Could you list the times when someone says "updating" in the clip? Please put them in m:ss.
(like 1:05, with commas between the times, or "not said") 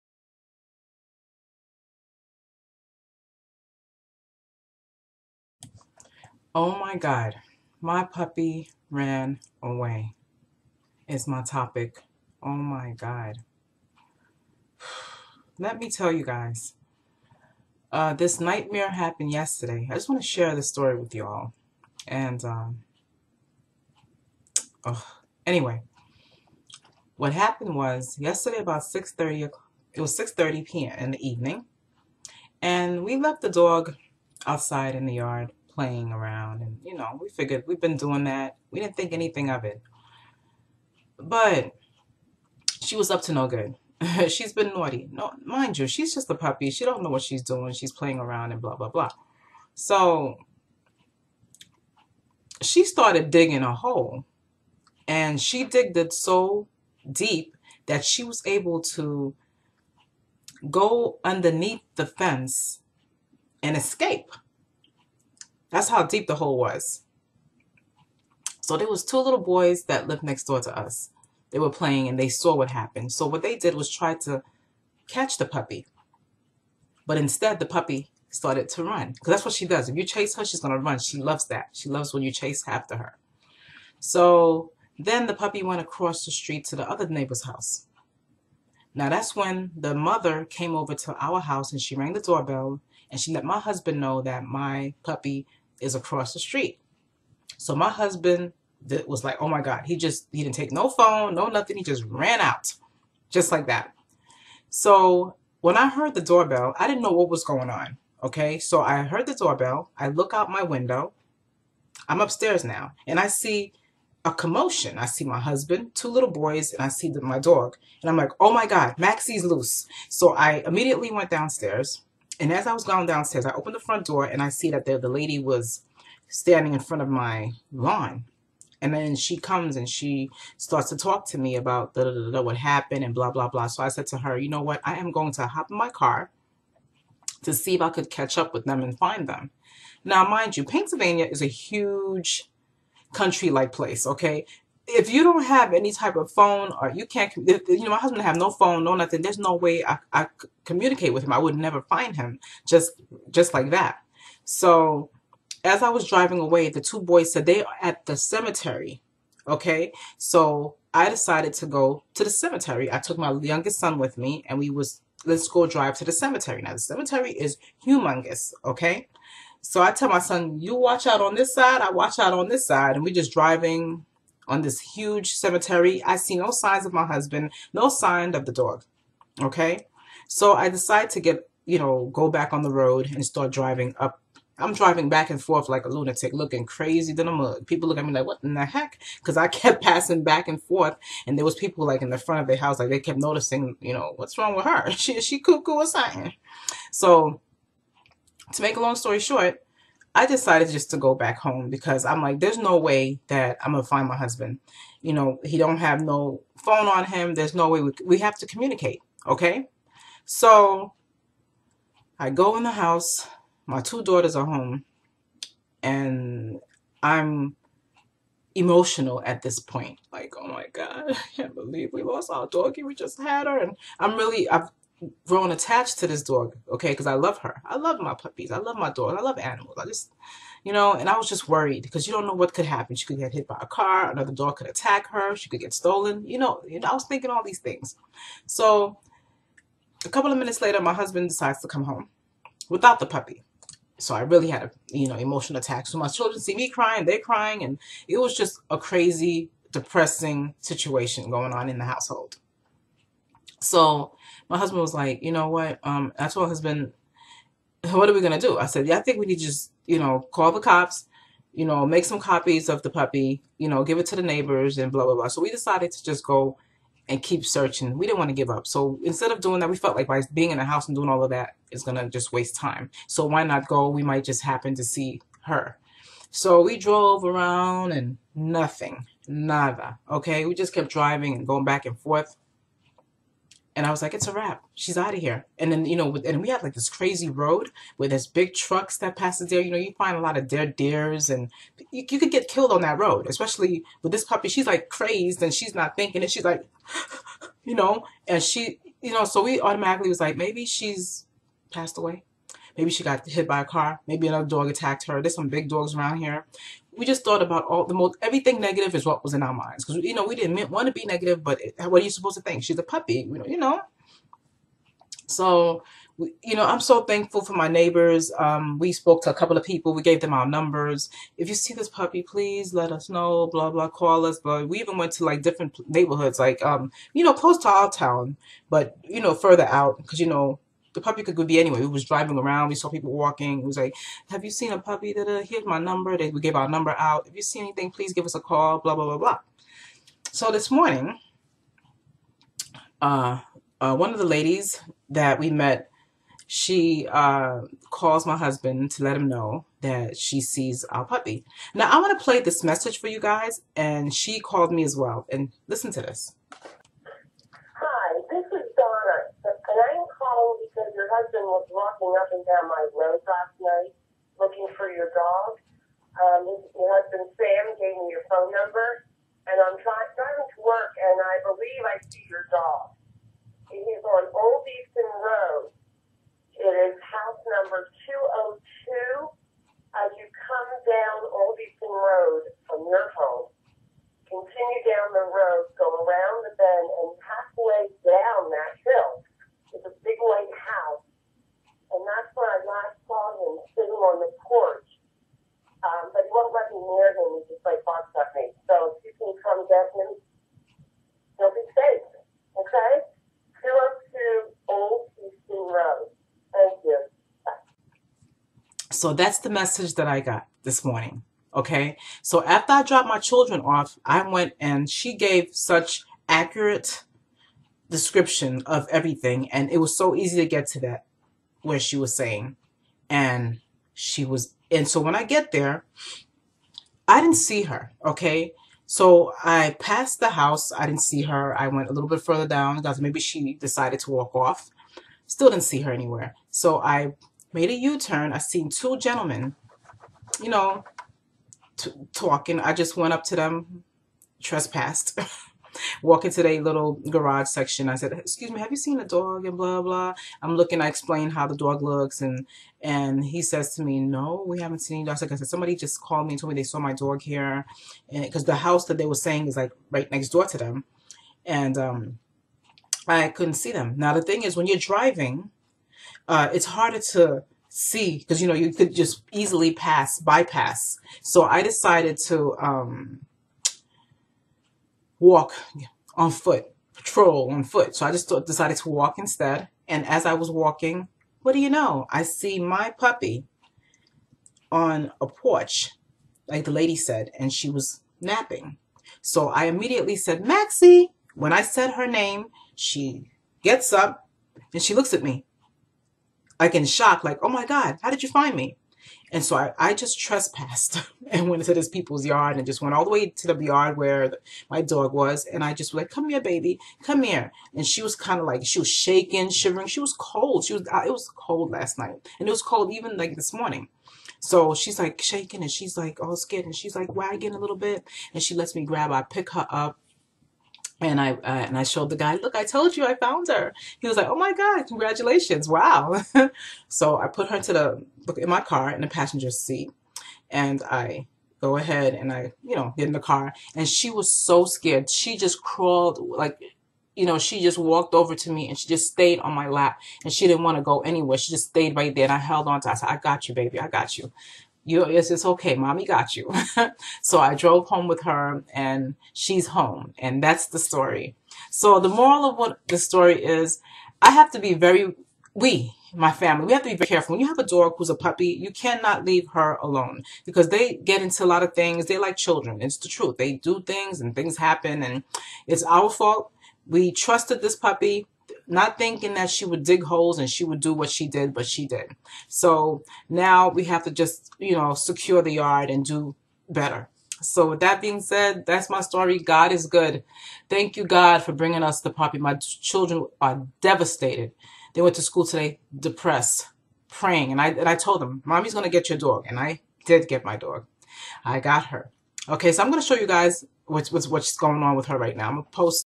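not said.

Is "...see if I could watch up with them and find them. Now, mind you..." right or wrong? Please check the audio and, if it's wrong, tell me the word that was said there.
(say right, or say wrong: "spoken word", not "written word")
wrong: "catch", not "watch".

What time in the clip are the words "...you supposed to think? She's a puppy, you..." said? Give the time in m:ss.
5:12.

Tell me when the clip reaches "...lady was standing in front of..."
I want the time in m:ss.
2:05.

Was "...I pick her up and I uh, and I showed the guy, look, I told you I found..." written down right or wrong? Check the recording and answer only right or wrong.
right.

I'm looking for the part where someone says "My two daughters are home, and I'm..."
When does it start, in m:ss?
3:33.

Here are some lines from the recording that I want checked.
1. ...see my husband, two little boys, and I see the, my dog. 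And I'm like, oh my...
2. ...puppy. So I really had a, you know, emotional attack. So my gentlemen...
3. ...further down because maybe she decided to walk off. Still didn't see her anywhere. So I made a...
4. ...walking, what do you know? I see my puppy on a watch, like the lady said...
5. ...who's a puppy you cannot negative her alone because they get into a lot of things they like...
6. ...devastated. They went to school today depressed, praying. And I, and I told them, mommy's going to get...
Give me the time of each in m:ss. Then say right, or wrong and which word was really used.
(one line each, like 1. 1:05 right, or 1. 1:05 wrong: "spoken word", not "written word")
1. 1:55 right
2. 4:03 wrong: "children", not "gentlemen"
3. 7:12 right
4. 8:00 wrong: "porch", not "watch"
5. 9:17 wrong: "leave", not "negative"
6. 9:43 right.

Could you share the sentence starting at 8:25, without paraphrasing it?
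And I just was like, come here, baby, come here.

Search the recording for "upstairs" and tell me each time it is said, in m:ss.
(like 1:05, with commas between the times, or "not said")
1:52.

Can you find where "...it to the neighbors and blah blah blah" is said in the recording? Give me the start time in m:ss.
4:23.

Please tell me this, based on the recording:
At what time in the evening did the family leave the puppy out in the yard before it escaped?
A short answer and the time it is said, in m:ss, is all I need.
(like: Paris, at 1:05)
6:30 p.m., at 0:30.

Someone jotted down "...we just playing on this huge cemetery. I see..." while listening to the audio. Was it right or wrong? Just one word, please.
wrong.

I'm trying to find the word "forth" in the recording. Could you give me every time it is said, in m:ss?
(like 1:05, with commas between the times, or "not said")
3:05, 3:10, 4:41.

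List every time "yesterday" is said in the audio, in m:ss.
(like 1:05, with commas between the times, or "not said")
0:19, 0:28.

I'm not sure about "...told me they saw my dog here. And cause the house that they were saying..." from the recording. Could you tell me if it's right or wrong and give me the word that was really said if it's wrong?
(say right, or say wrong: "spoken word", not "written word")
right.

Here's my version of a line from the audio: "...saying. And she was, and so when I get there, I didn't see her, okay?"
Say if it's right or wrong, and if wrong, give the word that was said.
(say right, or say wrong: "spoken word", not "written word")
right.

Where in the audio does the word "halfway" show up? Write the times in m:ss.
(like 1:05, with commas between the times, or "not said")
6:27.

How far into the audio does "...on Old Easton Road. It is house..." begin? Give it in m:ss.
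6:14.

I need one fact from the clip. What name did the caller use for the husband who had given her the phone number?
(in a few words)
Sam.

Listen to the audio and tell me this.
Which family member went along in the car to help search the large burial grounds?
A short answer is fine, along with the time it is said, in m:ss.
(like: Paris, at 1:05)
Youngest son, at 2:43.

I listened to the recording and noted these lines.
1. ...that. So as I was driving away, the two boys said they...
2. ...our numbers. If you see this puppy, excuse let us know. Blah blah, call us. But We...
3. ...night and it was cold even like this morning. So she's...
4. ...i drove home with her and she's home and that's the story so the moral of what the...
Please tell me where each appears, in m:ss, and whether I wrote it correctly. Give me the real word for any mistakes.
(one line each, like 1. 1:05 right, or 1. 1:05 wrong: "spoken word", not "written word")
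1. 2:33 right
2. 5:20 wrong: "please", not "excuse"
3. 8:31 right
4. 9:07 right.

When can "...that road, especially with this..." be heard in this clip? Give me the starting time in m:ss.
4:52.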